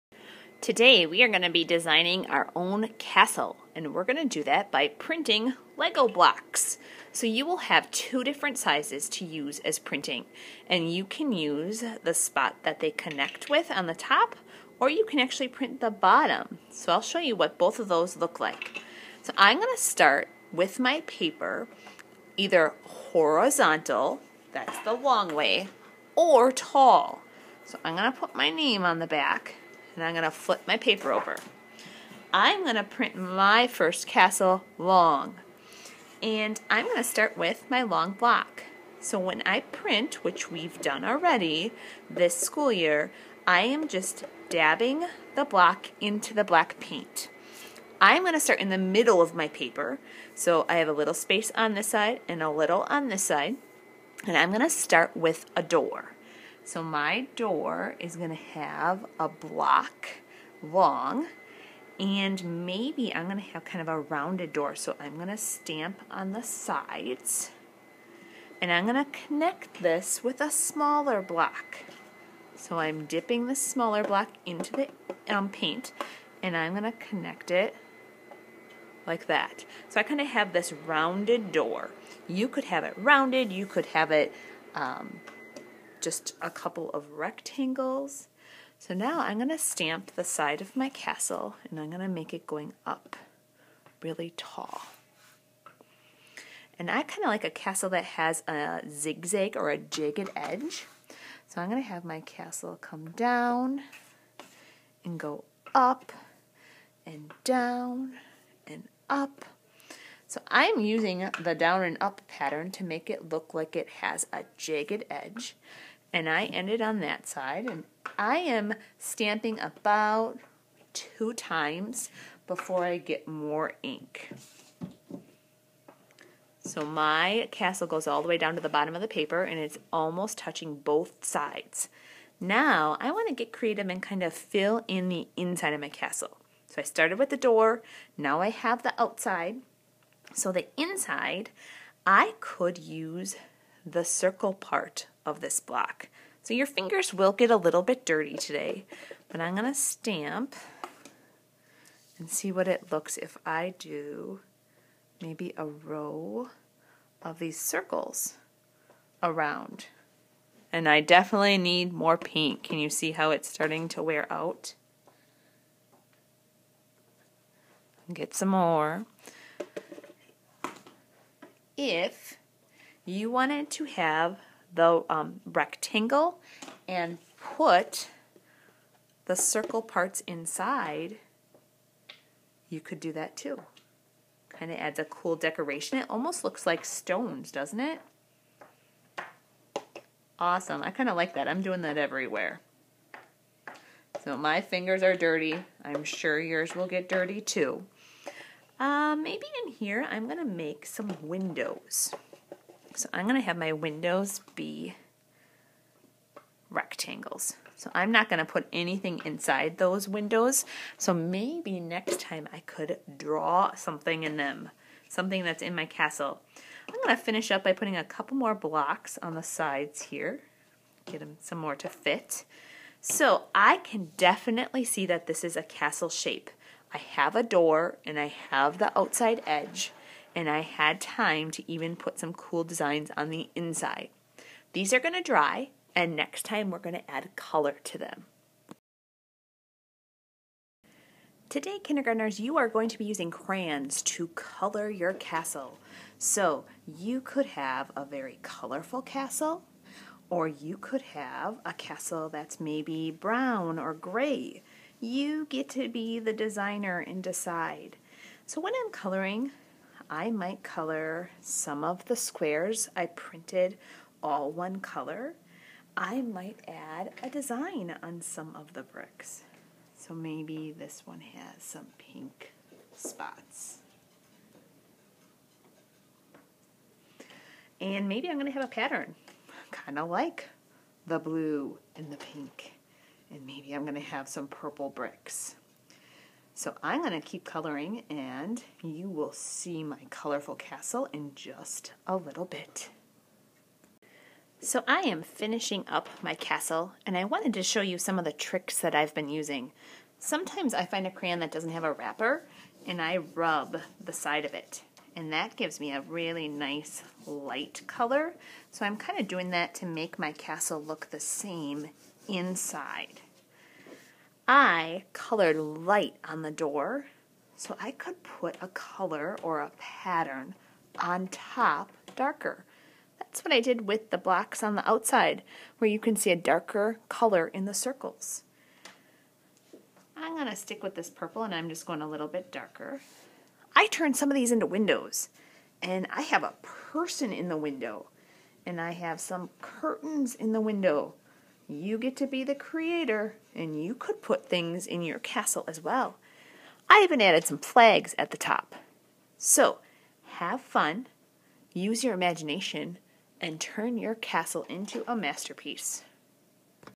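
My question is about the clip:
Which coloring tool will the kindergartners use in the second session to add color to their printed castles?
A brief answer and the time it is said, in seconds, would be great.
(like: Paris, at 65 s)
crayons, at 243 s.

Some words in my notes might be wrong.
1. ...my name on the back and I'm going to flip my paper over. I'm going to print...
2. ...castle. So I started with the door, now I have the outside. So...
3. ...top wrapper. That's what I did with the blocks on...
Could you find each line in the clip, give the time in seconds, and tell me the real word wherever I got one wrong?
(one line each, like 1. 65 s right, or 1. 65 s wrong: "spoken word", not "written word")
1. 28 s right
2. 135 s right
3. 321 s wrong: "darker", not "wrapper".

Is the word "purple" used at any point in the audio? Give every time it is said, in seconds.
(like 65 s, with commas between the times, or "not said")
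284 s, 331 s.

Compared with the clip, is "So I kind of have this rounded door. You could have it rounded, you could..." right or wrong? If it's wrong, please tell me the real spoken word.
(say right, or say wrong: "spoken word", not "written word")
right.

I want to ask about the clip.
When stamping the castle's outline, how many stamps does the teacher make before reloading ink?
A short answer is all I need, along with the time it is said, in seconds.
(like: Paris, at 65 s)
2, at 120 s.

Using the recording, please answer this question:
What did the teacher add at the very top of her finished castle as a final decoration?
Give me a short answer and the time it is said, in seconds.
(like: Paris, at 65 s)
flags, at 347 s.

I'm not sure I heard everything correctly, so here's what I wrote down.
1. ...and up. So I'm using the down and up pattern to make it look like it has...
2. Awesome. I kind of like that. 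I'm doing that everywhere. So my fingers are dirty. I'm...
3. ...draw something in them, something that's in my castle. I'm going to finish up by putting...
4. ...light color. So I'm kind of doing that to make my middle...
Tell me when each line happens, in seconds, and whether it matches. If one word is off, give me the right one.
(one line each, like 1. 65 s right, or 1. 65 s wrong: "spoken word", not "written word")
1. 108 s right
2. 190 s right
3. 213 s right
4. 307 s wrong: "castle", not "middle".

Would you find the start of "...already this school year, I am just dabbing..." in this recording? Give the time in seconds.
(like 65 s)
41 s.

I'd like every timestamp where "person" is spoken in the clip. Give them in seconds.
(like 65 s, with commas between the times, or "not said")
336 s.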